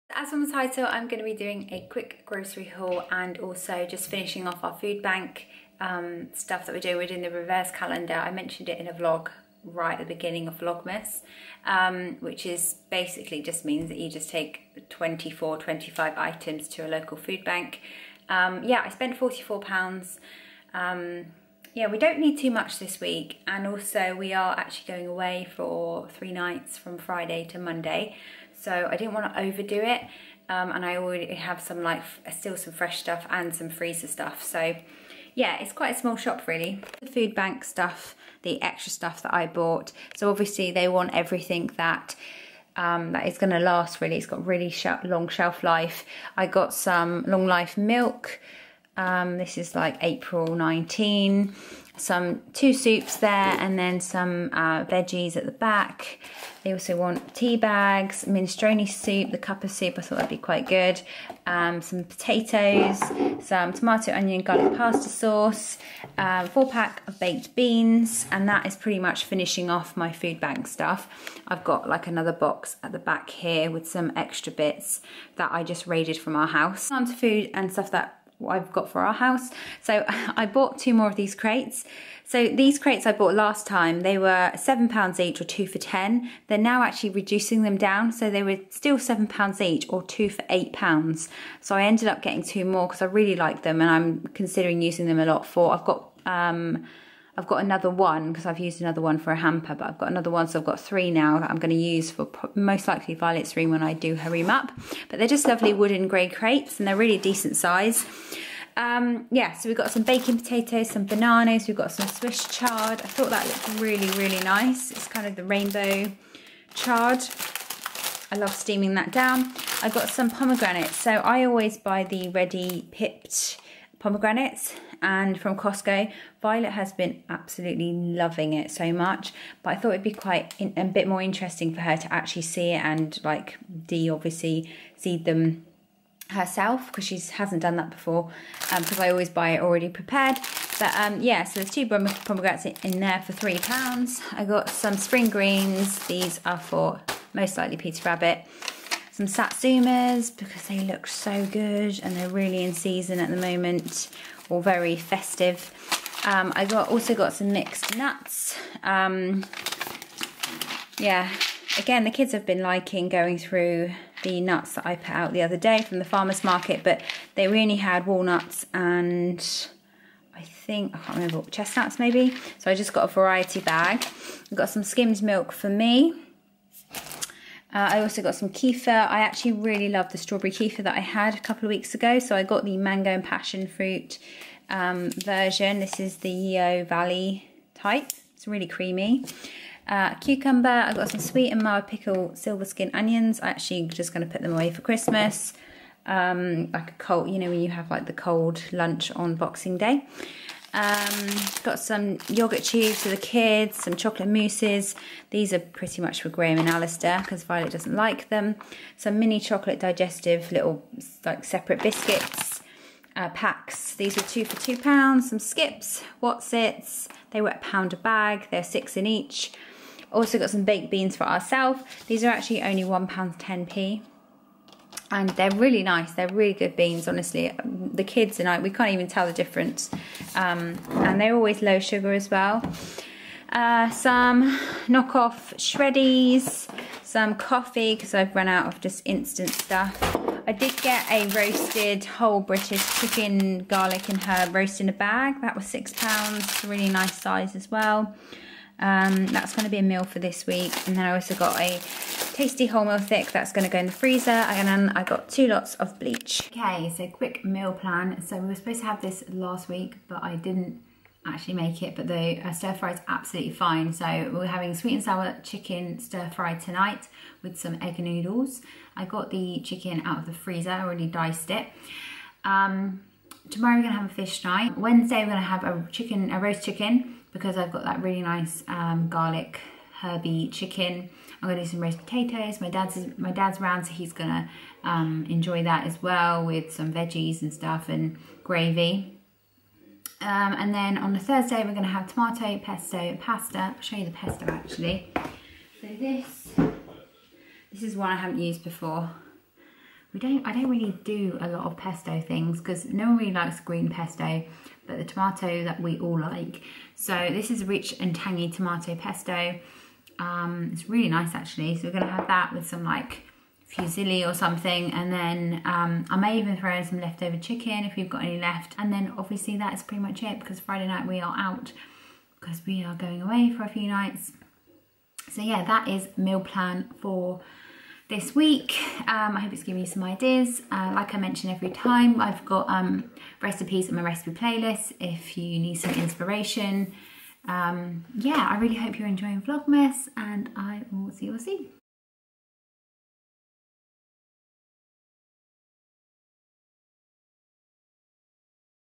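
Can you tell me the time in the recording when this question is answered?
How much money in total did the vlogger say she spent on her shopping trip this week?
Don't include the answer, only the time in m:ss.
0:19.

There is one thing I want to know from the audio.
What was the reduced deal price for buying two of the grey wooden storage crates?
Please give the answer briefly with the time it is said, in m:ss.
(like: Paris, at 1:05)
£8, at 1:30.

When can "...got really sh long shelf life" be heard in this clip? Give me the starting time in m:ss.
0:44.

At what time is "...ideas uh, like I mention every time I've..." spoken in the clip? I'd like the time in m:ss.
5:30.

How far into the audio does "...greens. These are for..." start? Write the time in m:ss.
2:25.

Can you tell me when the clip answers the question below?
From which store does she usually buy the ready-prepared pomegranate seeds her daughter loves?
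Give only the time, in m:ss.
2:05.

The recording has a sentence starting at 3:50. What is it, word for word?
Um, and they're always low sugar as well.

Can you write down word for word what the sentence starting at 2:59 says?
I actually really love the strawberry kefir that I had a couple of weeks ago.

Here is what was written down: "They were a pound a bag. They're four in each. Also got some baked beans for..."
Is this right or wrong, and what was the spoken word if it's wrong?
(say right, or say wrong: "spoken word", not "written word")
wrong: "six", not "four".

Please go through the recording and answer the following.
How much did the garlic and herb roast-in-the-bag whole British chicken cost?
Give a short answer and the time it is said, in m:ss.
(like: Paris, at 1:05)
£6, at 4:05.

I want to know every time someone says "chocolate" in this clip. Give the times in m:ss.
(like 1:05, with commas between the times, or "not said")
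3:23, 3:29.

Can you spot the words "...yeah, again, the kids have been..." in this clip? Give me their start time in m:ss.
2:40.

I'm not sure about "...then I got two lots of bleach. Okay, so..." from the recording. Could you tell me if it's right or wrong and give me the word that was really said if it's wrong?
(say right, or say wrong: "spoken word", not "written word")
right.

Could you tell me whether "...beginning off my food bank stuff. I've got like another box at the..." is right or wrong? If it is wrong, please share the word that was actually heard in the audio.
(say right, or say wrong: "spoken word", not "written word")
wrong: "finishing", not "beginning".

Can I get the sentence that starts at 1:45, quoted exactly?
But they're just lovely wooden grey crates and they're really decent size.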